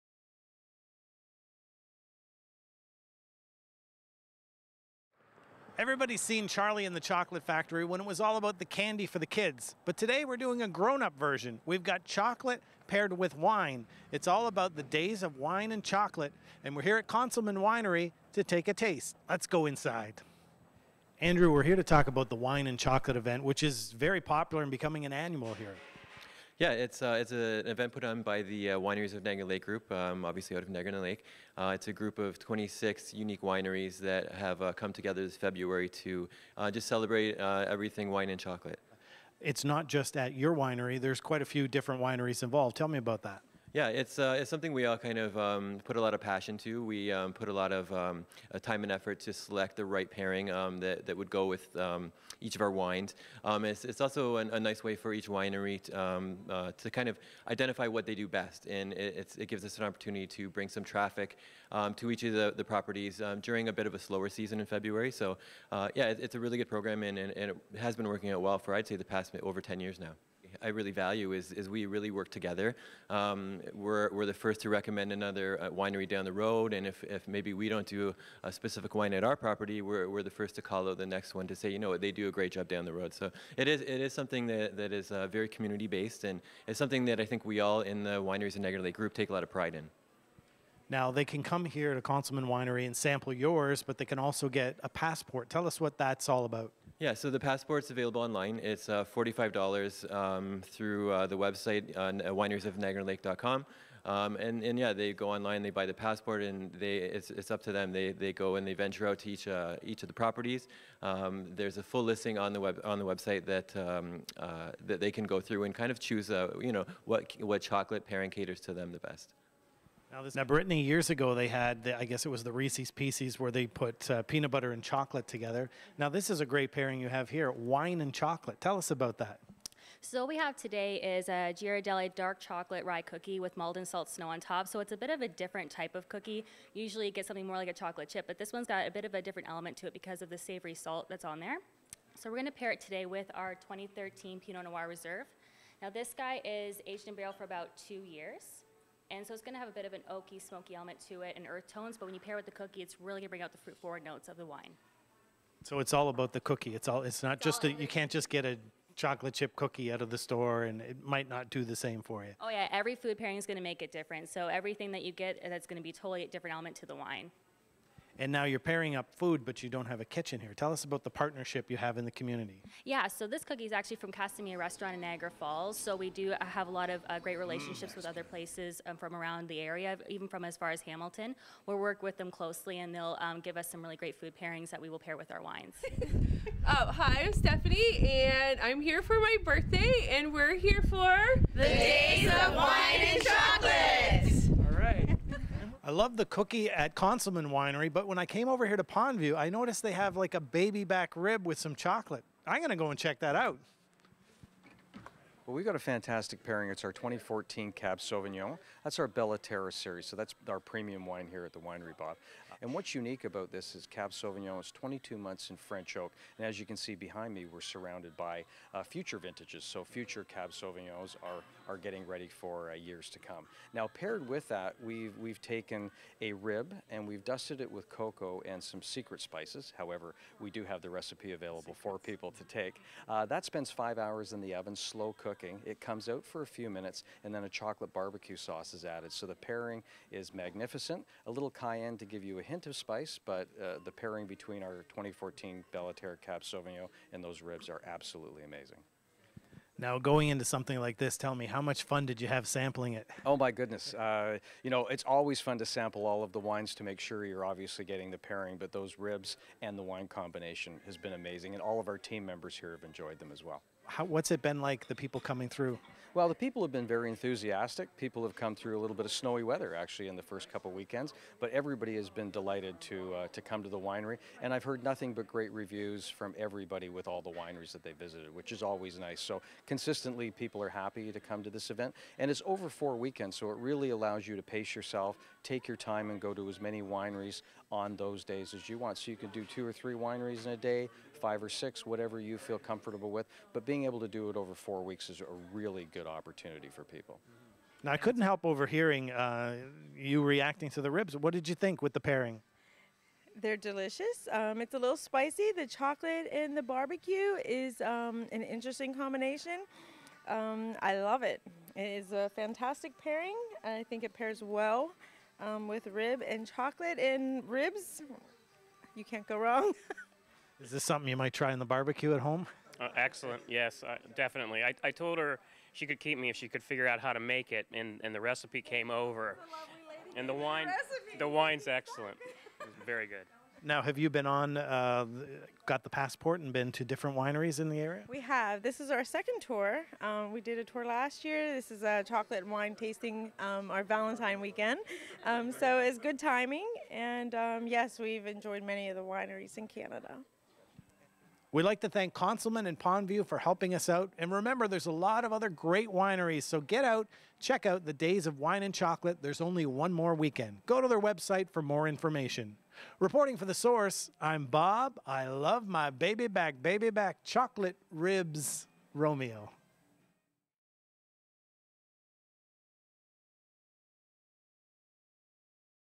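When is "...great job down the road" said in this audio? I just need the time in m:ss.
1:22.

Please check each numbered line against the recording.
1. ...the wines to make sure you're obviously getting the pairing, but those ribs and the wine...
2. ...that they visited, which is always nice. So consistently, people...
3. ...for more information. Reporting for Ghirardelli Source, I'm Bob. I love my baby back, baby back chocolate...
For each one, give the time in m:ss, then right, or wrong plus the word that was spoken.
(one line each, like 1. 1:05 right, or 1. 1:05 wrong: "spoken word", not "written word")
1. 4:16 right
2. 4:37 right
3. 6:01 wrong: "The", not "Ghirardelli".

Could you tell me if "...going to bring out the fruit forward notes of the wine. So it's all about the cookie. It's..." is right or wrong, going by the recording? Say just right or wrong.
right.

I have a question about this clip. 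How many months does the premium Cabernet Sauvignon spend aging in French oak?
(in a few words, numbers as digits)
22.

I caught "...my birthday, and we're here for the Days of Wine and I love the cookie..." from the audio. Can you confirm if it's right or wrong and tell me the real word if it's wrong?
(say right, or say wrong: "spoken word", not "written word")
right.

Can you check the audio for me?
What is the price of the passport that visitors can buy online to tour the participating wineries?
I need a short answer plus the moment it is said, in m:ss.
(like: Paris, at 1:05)
$45, at 1:39.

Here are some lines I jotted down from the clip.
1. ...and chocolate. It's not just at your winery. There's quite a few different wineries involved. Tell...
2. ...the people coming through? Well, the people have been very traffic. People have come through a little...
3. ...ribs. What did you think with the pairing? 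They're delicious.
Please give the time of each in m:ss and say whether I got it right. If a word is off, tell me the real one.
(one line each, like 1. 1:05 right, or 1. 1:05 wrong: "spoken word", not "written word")
1. 0:38 right
2. 4:24 wrong: "enthusiastic", not "traffic"
3. 5:00 right.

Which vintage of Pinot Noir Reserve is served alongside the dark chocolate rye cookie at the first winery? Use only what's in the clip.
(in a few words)
2013.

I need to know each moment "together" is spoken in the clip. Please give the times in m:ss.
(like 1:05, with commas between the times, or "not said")
0:34, 1:12, 2:05.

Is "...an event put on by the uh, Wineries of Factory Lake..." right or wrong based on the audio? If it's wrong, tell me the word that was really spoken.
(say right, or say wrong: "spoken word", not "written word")
wrong: "Niagara", not "Factory".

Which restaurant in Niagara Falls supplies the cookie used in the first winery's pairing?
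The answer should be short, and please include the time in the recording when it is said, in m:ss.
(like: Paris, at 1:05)
Casimir Restaurant, at 2:54.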